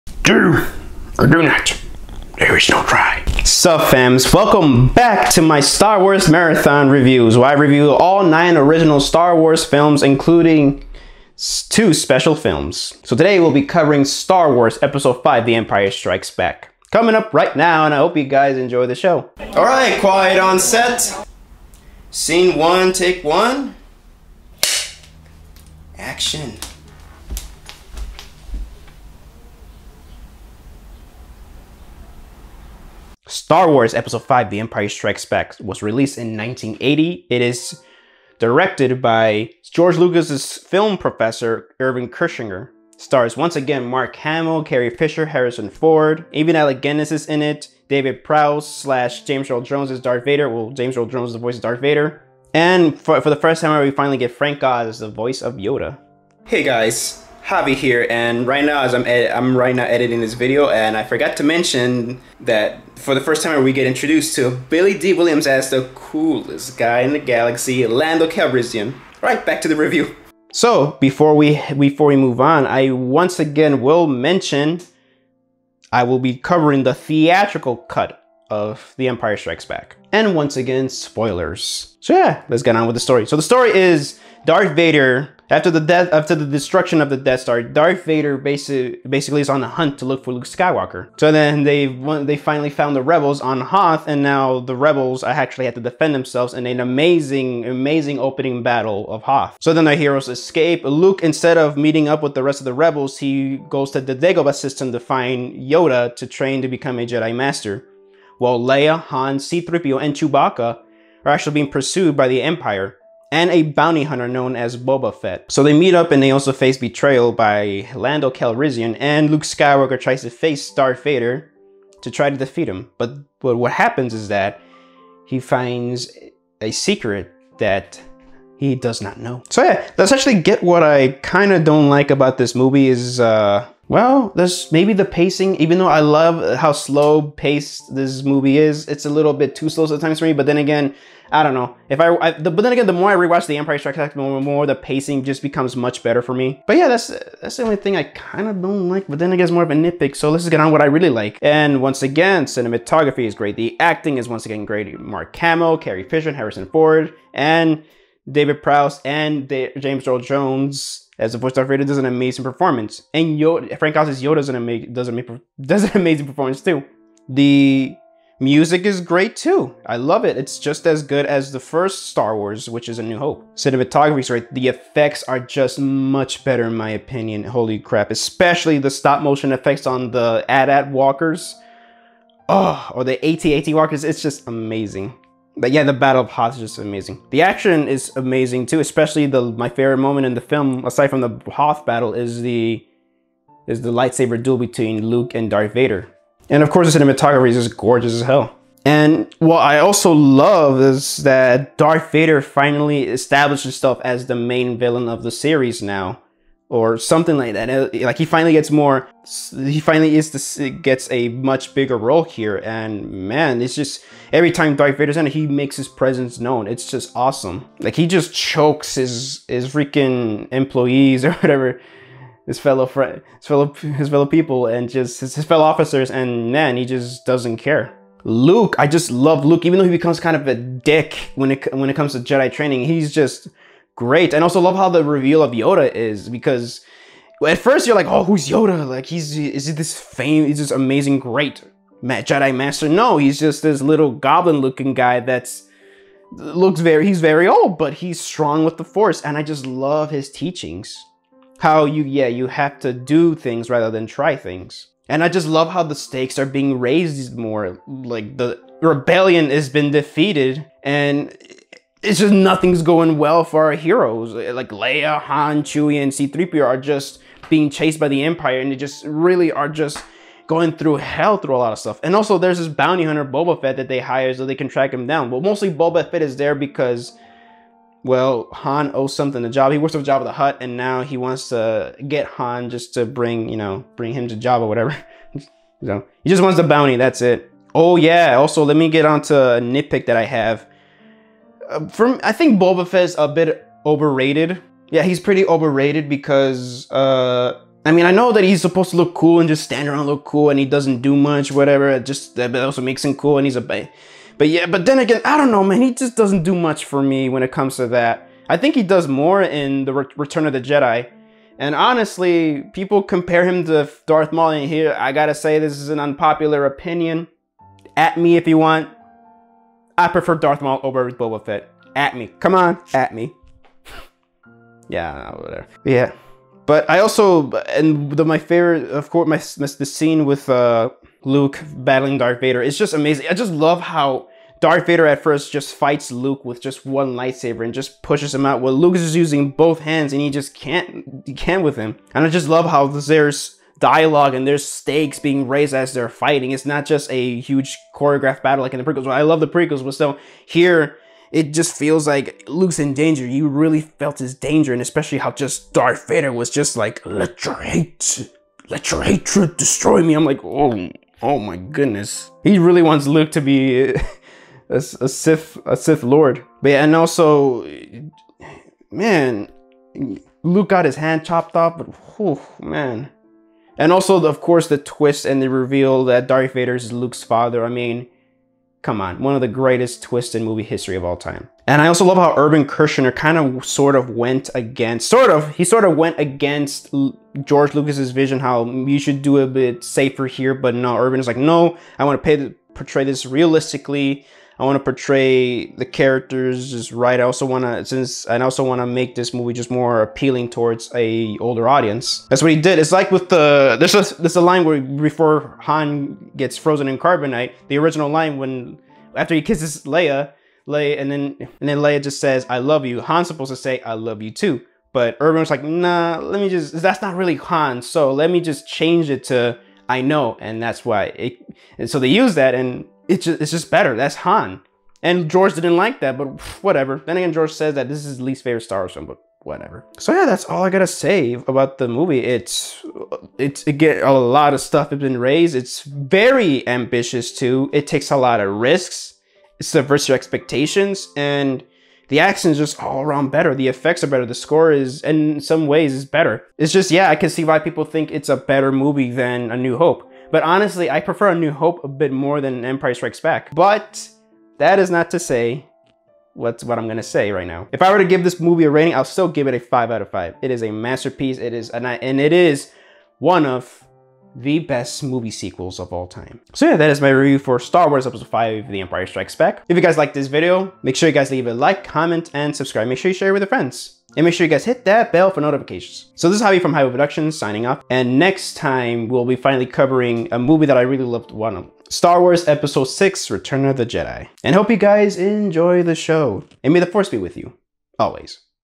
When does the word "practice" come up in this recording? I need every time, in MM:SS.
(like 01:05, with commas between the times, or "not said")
not said.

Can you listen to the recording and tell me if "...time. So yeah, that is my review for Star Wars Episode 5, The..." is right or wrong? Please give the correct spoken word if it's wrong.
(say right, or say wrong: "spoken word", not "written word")
right.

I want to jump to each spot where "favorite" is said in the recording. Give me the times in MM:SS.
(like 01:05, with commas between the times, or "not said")
03:09, 05:28, 07:08.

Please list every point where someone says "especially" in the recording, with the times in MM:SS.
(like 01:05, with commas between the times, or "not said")
02:58, 03:08, 05:54.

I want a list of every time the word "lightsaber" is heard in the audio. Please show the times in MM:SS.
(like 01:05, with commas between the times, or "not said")
03:13, 05:37.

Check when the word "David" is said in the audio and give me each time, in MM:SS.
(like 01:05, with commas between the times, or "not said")
00:47, 02:38.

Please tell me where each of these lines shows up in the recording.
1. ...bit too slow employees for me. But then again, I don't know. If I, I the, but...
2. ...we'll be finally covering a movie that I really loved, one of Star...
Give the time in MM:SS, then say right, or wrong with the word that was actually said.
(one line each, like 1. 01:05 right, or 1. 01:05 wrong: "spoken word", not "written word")
1. 02:19 wrong: "sometimes", not "employees"
2. 07:59 right.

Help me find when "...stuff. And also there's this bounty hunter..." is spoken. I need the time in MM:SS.
04:31.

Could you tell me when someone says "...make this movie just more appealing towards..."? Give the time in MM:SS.
06:38.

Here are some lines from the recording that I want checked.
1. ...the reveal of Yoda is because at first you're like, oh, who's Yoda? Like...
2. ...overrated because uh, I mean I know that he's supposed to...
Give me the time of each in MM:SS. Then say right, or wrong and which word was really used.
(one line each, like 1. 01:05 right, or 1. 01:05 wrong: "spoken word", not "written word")
1. 03:54 right
2. 04:55 right.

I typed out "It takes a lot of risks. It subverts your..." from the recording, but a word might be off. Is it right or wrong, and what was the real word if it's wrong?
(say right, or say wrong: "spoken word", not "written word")
right.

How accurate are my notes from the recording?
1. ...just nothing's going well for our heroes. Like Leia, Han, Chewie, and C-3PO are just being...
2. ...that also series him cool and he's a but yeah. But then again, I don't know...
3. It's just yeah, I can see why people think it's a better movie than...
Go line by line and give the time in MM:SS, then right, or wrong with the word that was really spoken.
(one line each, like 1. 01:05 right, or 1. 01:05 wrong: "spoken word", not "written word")
1. 04:22 right
2. 05:02 wrong: "makes", not "series"
3. 07:26 right.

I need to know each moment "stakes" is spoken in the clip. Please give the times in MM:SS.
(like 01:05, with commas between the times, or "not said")
04:15, 05:44.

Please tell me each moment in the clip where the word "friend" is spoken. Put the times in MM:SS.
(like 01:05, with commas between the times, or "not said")
03:42, 07:53.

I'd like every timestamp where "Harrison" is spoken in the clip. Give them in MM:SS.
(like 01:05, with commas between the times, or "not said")
00:45, 02:36.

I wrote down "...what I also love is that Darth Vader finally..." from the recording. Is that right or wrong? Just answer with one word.
right.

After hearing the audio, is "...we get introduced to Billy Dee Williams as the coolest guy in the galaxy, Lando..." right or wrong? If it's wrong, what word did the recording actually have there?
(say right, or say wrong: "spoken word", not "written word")
right.